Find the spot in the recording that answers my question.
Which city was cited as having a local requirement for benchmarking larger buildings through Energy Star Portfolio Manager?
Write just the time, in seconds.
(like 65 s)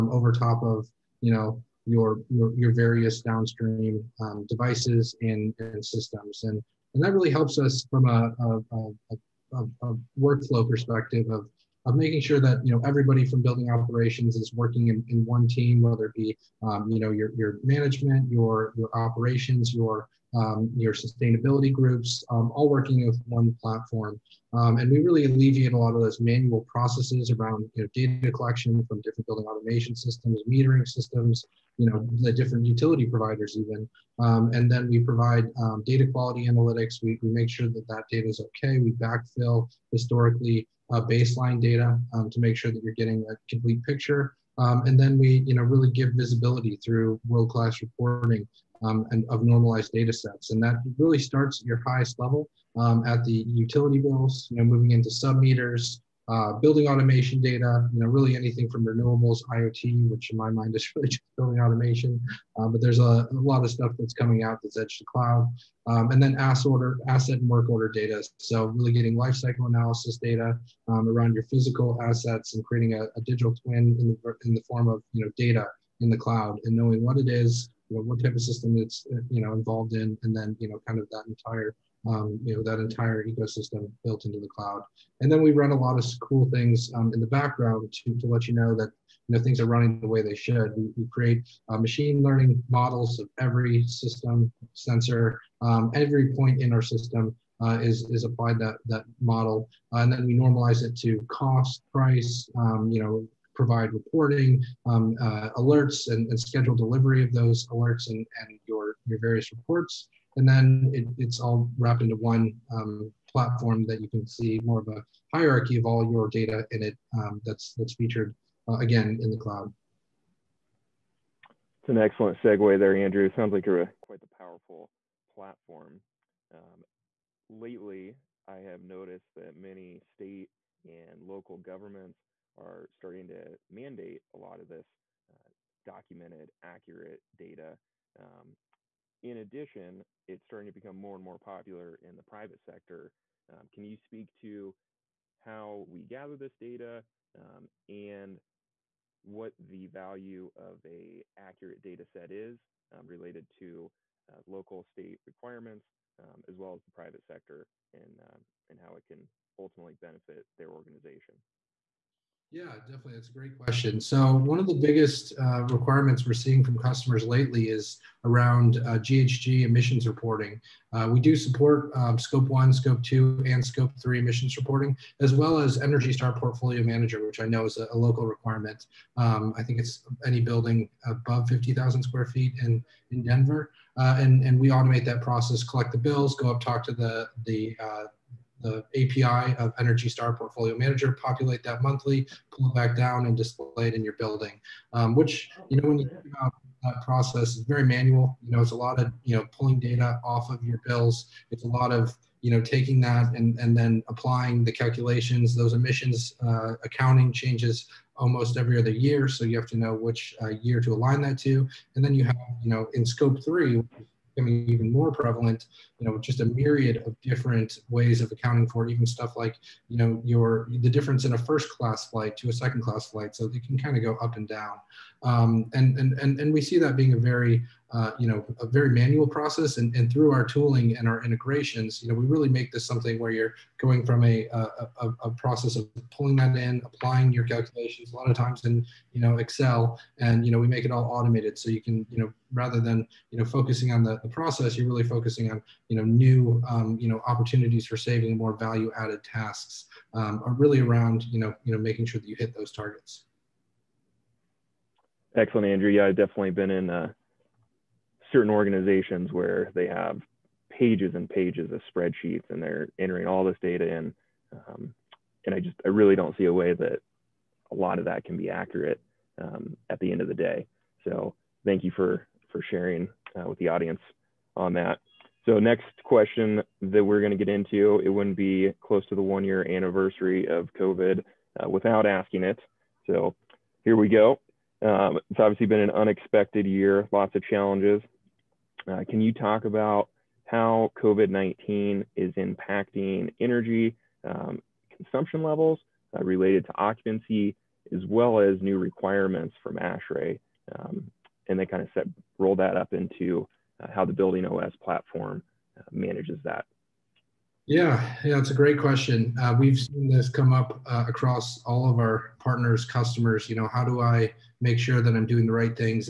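183 s.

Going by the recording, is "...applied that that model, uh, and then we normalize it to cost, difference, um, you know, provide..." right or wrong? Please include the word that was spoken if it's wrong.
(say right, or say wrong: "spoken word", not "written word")
wrong: "price", not "difference".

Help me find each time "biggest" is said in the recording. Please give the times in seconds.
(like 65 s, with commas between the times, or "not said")
164 s.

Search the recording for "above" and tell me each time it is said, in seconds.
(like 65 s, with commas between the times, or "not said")
181 s.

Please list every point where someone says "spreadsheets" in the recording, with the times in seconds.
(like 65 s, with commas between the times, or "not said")
261 s.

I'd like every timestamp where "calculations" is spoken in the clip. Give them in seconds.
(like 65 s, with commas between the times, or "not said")
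204 s, 237 s.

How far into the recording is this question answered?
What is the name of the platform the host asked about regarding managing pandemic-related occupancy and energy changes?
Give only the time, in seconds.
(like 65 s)
304 s.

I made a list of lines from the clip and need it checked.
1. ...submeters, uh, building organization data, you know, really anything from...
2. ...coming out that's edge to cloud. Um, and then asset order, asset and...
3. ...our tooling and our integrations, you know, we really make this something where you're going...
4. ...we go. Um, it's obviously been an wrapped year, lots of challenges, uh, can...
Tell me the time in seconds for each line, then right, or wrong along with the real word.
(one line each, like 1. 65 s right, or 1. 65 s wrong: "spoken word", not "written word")
1. 55 s wrong: "automation", not "organization"
2. 64 s right
3. 230 s right
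4. 283 s wrong: "unexpected", not "wrapped".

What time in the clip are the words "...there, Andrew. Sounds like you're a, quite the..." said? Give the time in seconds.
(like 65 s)
122 s.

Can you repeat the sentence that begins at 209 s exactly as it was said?
So you have to know which uh, year to align that to.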